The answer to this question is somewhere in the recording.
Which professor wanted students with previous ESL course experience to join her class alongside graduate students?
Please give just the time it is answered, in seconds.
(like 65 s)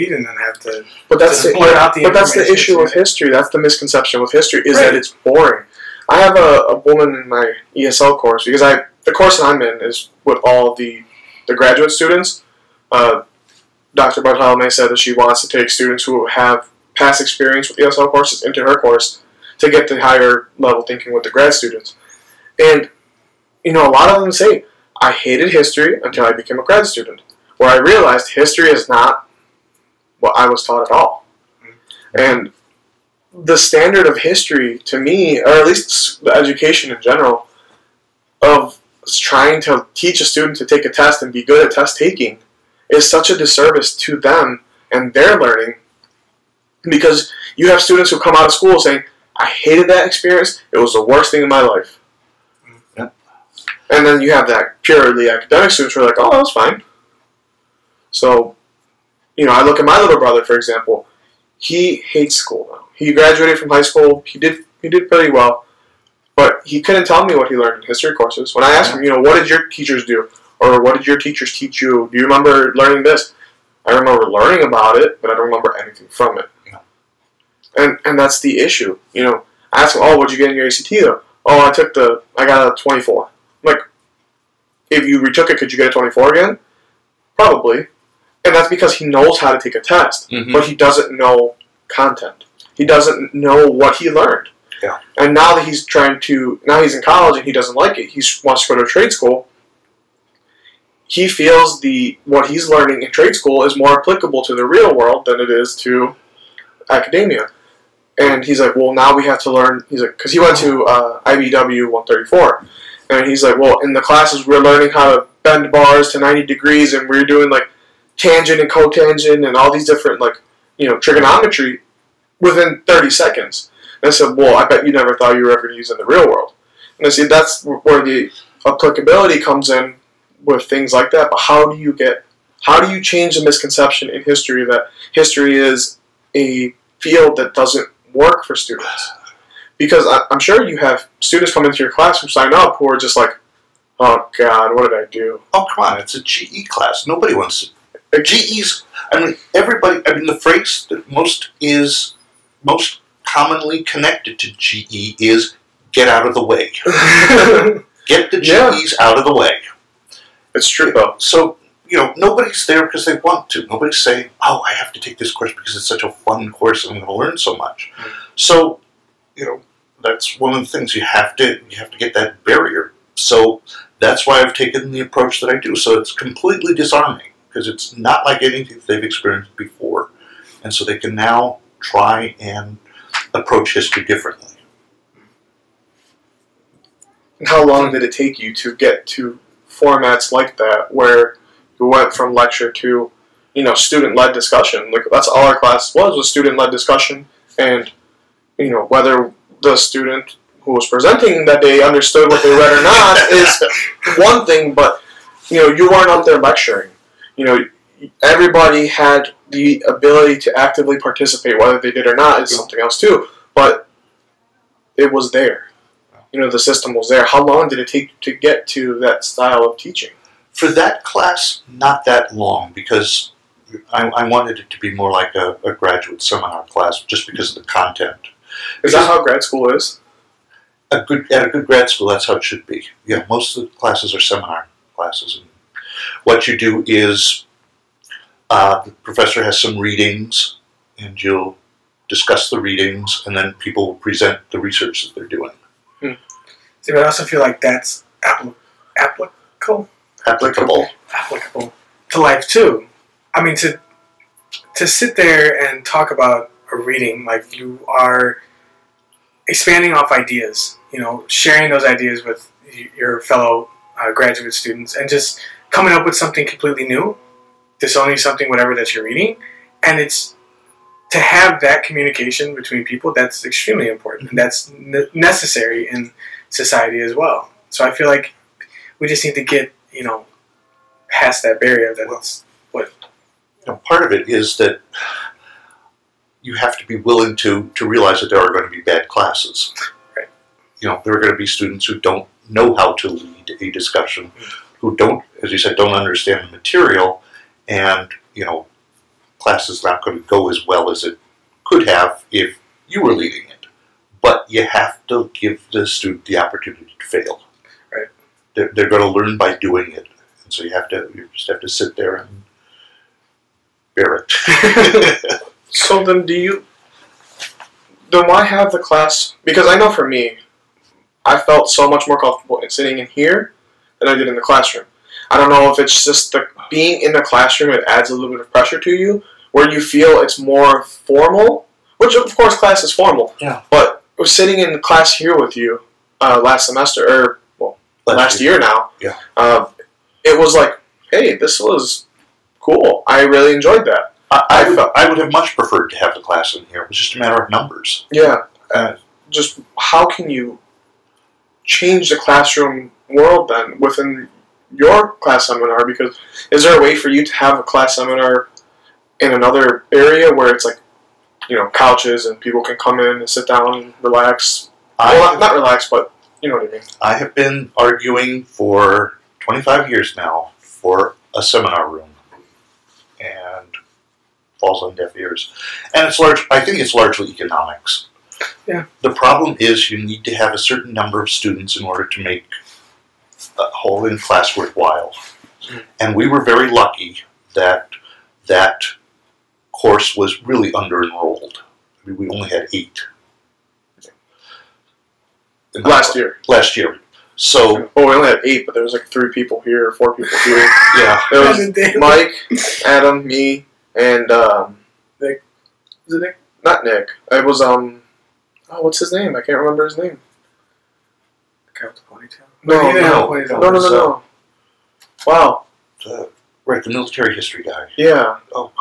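13 s.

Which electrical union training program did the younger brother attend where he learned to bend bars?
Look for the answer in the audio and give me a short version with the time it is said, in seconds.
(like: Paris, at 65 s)
IBEW 134, at 111 s.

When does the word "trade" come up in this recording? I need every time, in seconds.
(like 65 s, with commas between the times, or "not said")
98 s, 103 s.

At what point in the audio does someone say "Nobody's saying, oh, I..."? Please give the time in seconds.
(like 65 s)
163 s.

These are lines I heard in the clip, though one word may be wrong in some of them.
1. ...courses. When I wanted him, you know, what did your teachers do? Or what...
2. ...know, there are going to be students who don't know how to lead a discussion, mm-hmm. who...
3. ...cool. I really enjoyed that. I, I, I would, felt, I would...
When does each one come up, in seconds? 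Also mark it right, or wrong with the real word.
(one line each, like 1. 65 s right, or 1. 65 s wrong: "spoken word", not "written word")
1. 68 s wrong: "asked", not "wanted"
2. 290 s right
3. 342 s right.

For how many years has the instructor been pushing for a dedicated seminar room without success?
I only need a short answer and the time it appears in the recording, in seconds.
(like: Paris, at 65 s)
25 years, at 369 s.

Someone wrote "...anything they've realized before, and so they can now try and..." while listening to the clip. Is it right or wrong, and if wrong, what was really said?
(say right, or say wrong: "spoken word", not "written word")
wrong: "experienced", not "realized".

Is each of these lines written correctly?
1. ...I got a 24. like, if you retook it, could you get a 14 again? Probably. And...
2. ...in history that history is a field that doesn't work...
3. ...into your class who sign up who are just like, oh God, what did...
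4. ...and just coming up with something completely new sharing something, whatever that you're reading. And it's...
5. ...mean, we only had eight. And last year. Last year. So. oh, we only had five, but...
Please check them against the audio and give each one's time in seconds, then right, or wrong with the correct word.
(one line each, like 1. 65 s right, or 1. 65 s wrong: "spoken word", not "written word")
1. 82 s wrong: "24", not "14"
2. 134 s right
3. 141 s right
4. 264 s wrong: "selling", not "sharing"
5. 392 s wrong: "eight", not "five".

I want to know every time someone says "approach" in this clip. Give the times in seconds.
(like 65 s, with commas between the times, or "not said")
174 s, 183 s.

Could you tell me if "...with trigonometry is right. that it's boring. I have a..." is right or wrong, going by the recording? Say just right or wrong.
wrong.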